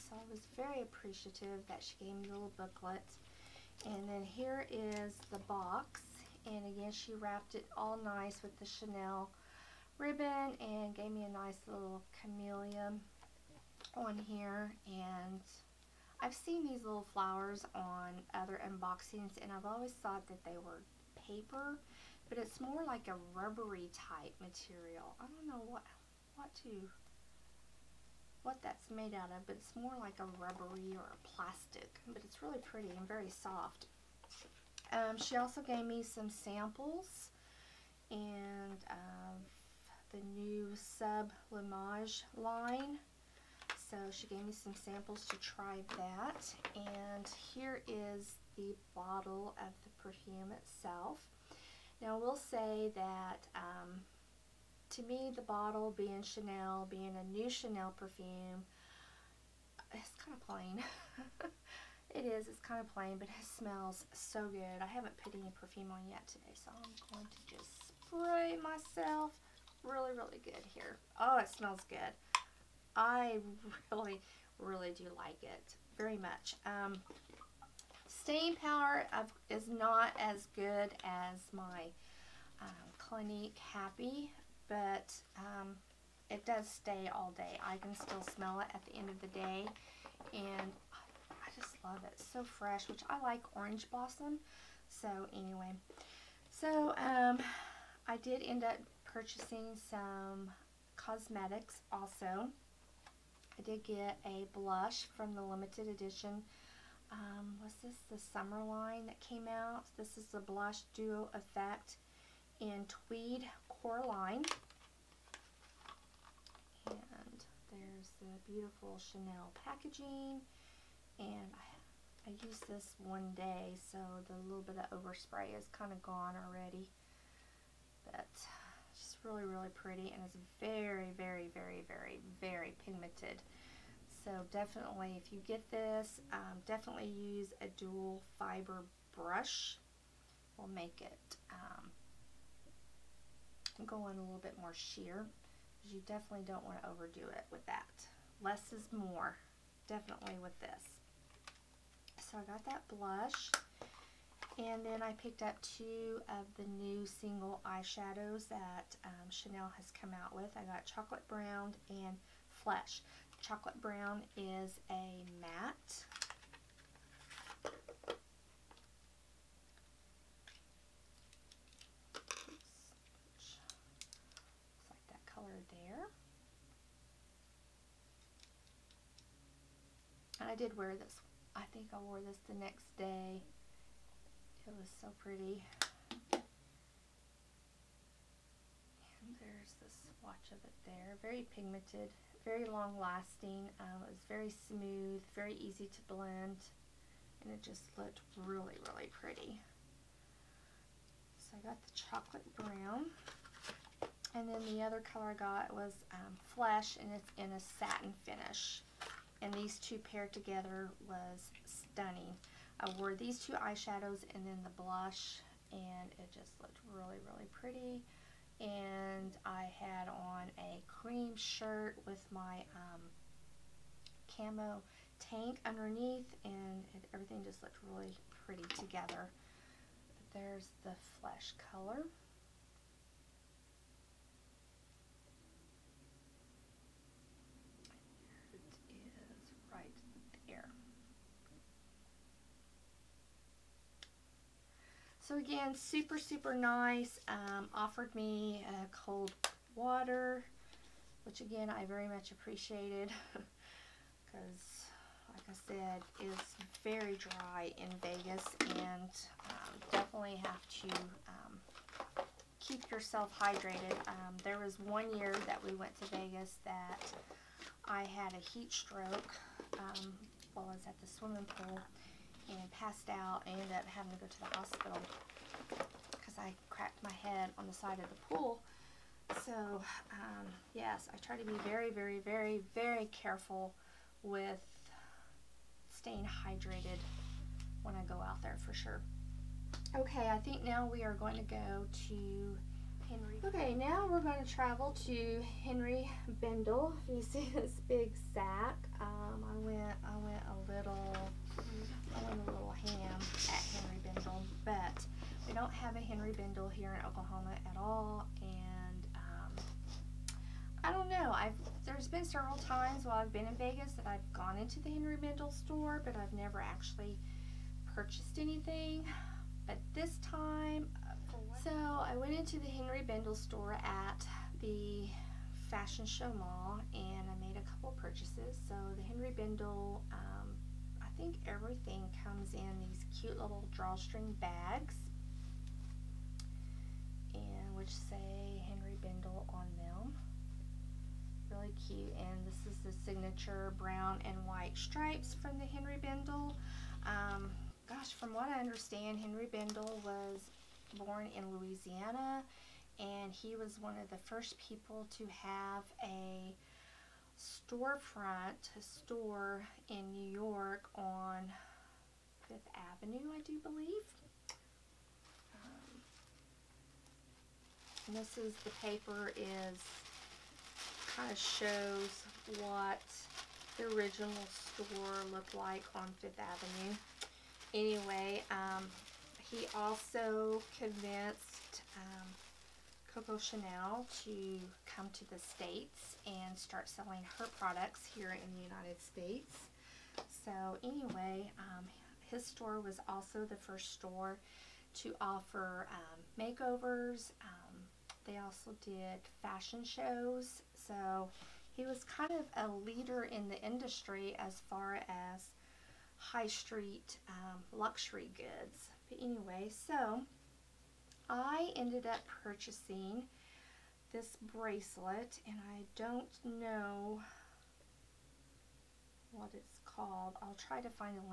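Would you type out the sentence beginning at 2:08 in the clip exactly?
But really, really pretty and it's very, very, very, very, very pigmented.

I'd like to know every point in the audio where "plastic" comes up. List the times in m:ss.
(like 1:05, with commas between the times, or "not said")
0:31.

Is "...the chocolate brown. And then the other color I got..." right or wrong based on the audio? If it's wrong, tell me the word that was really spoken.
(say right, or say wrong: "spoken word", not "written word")
right.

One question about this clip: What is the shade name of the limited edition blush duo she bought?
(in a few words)
Tweed Coraline.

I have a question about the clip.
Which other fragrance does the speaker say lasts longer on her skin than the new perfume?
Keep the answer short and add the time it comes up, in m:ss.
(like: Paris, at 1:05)
Clinique Happy, at 1:22.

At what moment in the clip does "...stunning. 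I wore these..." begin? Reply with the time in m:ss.
3:31.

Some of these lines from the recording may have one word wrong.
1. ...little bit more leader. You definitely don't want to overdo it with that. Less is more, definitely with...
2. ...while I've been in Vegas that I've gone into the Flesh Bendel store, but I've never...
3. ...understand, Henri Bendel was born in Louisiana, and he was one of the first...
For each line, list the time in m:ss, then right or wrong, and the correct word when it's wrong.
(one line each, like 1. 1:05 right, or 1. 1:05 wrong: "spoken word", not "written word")
1. 2:24 wrong: "sheer", not "leader"
2. 5:13 wrong: "Henri", not "Flesh"
3. 5:48 right.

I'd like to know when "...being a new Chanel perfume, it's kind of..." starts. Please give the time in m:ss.
0:56.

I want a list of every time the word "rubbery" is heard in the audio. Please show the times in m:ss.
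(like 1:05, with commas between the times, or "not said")
0:23, 0:30.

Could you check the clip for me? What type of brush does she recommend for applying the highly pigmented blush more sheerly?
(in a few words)
dual fiber brush.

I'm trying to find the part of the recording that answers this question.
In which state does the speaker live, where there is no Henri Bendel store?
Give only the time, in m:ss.
5:07.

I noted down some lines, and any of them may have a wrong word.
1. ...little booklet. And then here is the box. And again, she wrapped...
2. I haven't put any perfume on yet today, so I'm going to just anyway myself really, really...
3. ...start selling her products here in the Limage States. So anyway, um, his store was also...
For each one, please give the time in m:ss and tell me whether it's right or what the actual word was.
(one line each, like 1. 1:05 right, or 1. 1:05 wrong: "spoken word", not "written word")
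1. 0:02 right
2. 1:04 wrong: "spray", not "anyway"
3. 6:26 wrong: "United", not "Limage".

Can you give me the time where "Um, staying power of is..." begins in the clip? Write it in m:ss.
1:16.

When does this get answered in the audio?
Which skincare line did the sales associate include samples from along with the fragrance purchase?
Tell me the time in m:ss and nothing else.
0:40.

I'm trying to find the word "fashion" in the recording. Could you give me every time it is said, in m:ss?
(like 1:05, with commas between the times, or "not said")
5:25, 6:39.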